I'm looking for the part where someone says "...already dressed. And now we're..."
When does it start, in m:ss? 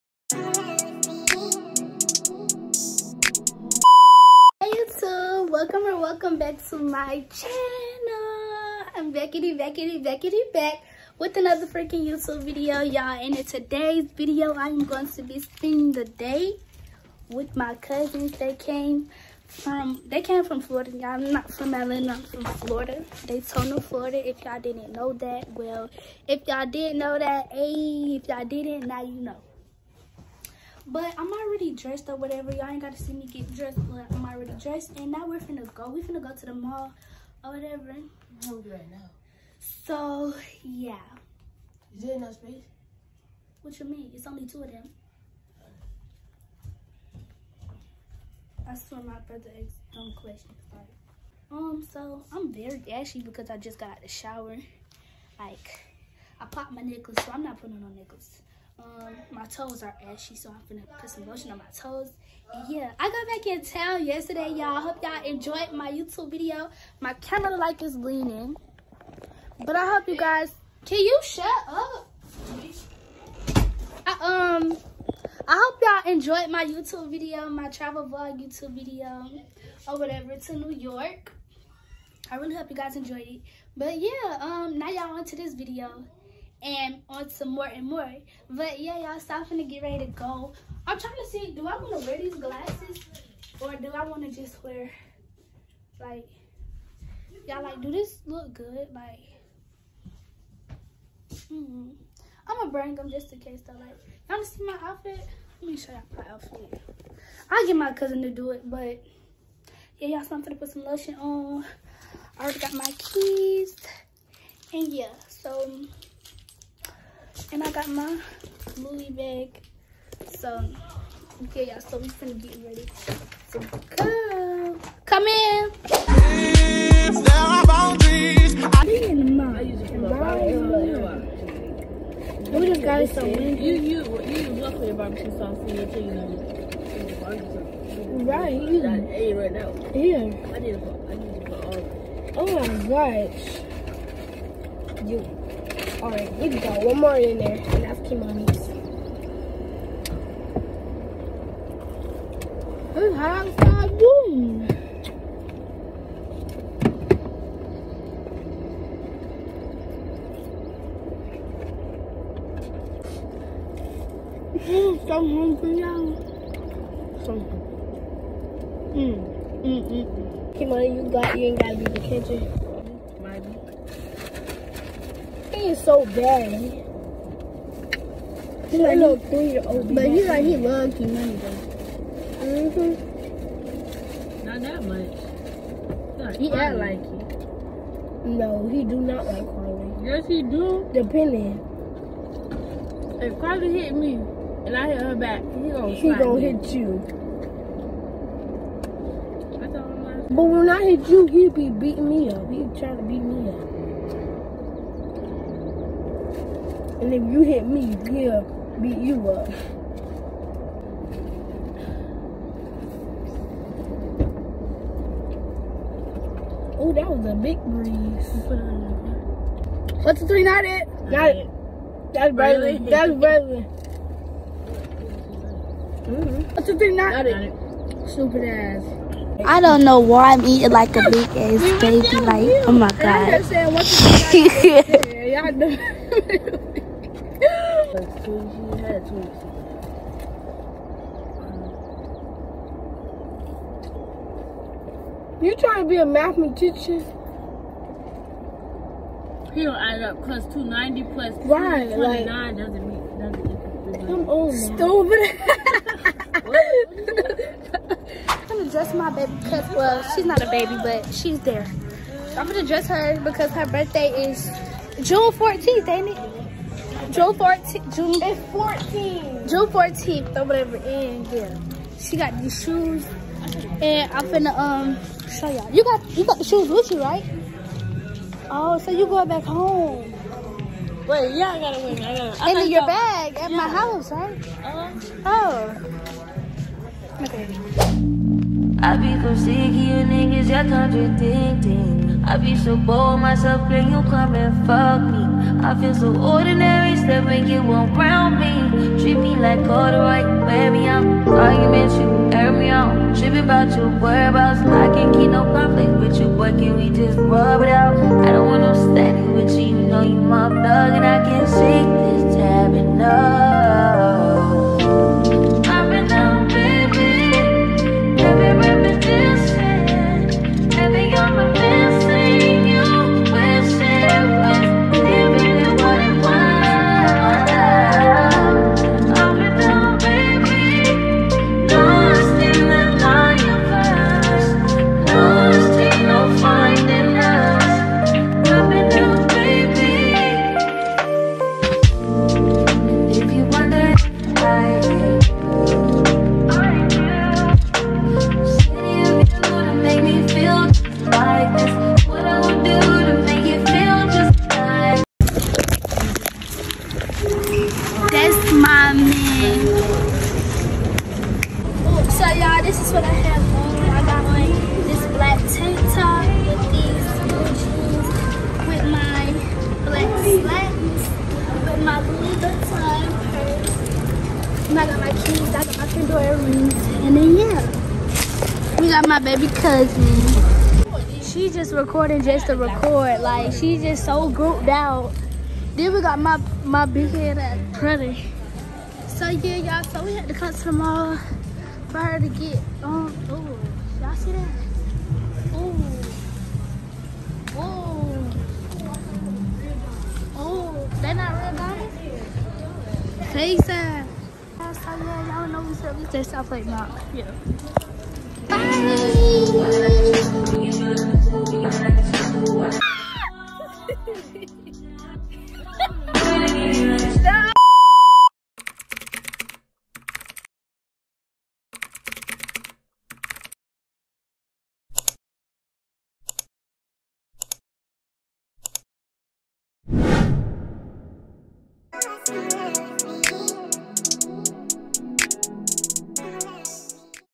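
0:34.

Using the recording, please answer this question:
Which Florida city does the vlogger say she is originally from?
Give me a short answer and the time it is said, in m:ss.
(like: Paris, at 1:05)
Daytona, at 0:23.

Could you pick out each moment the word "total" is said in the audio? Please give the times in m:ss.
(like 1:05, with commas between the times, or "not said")
not said.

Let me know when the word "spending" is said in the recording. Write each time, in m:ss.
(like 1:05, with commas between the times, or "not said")
0:15.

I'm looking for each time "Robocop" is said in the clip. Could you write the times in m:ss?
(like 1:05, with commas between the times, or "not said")
not said.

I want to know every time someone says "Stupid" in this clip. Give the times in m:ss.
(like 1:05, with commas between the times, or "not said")
3:48, 4:15.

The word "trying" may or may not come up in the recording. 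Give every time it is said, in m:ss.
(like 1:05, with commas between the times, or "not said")
1:30, 3:22, 4:05.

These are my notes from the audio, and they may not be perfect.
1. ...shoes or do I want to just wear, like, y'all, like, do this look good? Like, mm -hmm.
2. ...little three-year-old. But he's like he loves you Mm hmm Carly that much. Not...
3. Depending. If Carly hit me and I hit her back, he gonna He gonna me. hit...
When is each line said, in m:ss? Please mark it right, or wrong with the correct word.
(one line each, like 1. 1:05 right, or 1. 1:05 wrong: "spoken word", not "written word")
1. 1:32 wrong: "glasses", not "shoes"
2. 2:58 wrong: "Not", not "Carly"
3. 3:10 right.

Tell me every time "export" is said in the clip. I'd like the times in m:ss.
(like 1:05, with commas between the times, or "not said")
not said.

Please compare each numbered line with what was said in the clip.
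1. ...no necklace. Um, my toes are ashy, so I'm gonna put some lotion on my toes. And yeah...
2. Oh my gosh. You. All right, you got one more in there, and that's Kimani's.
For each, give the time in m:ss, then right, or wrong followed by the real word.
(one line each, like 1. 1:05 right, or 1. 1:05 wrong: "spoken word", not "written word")
1. 0:57 right
2. 2:22 right.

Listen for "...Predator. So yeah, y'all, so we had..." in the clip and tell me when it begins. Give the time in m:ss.
6:27.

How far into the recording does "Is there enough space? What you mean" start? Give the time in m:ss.
0:41.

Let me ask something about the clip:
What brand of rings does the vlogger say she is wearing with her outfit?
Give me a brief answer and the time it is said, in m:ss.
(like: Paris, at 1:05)
Pandora, at 6:15.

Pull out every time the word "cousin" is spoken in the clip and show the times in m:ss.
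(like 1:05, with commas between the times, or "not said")
0:17, 1:47, 6:19.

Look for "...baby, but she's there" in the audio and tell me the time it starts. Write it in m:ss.
4:20.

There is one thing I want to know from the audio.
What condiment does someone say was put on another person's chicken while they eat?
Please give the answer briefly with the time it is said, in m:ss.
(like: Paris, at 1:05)
barbecue sauce, at 2:14.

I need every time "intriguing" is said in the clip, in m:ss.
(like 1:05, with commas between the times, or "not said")
not said.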